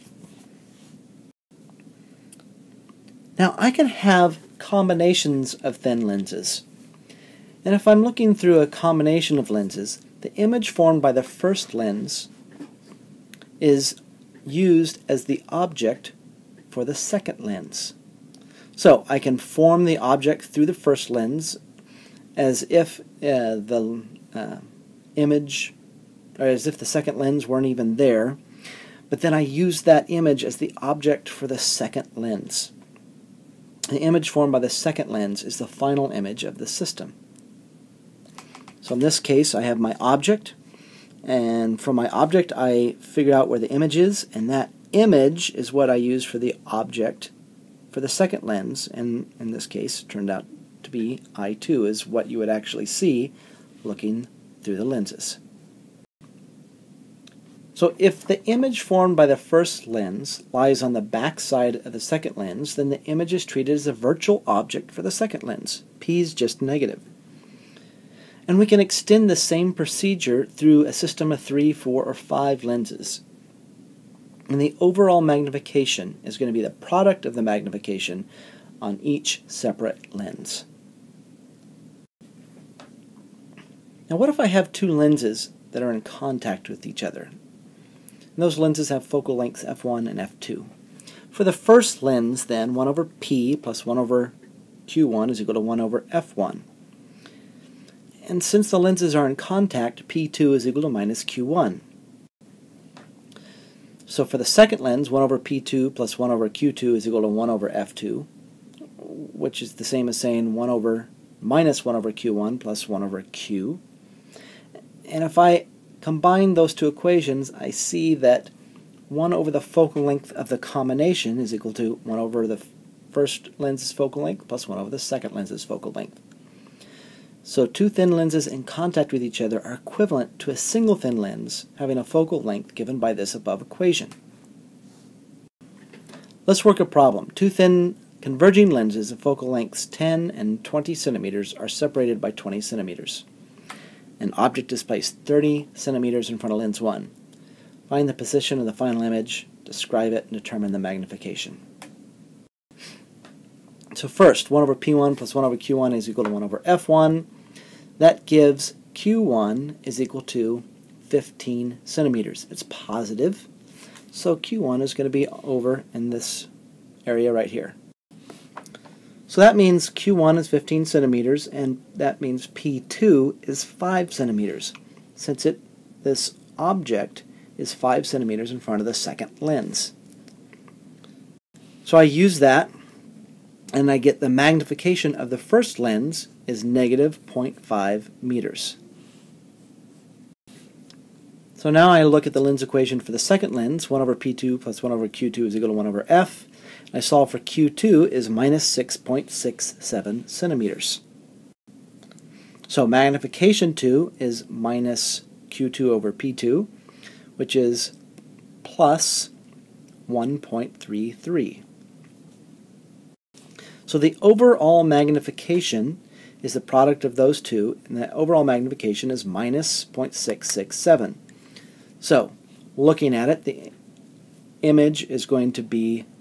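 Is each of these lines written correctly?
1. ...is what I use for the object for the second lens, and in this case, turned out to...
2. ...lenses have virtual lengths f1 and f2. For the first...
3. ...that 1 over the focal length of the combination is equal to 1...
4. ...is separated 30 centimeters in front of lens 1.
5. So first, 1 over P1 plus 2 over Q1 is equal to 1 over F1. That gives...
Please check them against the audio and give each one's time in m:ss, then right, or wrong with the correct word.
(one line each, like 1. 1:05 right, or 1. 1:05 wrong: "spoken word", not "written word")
1. 0:45 right
2. 1:28 wrong: "focal", not "virtual"
3. 1:58 right
4. 2:24 wrong: "placed", not "separated"
5. 2:33 wrong: "1", not "2".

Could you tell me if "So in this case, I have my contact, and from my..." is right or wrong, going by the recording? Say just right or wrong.
wrong.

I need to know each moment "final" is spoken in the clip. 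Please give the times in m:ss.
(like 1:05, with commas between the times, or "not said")
0:35, 2:28.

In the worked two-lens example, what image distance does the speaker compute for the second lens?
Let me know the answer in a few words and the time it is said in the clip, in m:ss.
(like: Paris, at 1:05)
-6.67 centimeters, at 3:18.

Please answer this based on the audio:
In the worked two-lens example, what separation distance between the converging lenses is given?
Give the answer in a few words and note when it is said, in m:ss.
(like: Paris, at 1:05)
20 centimeters, at 2:21.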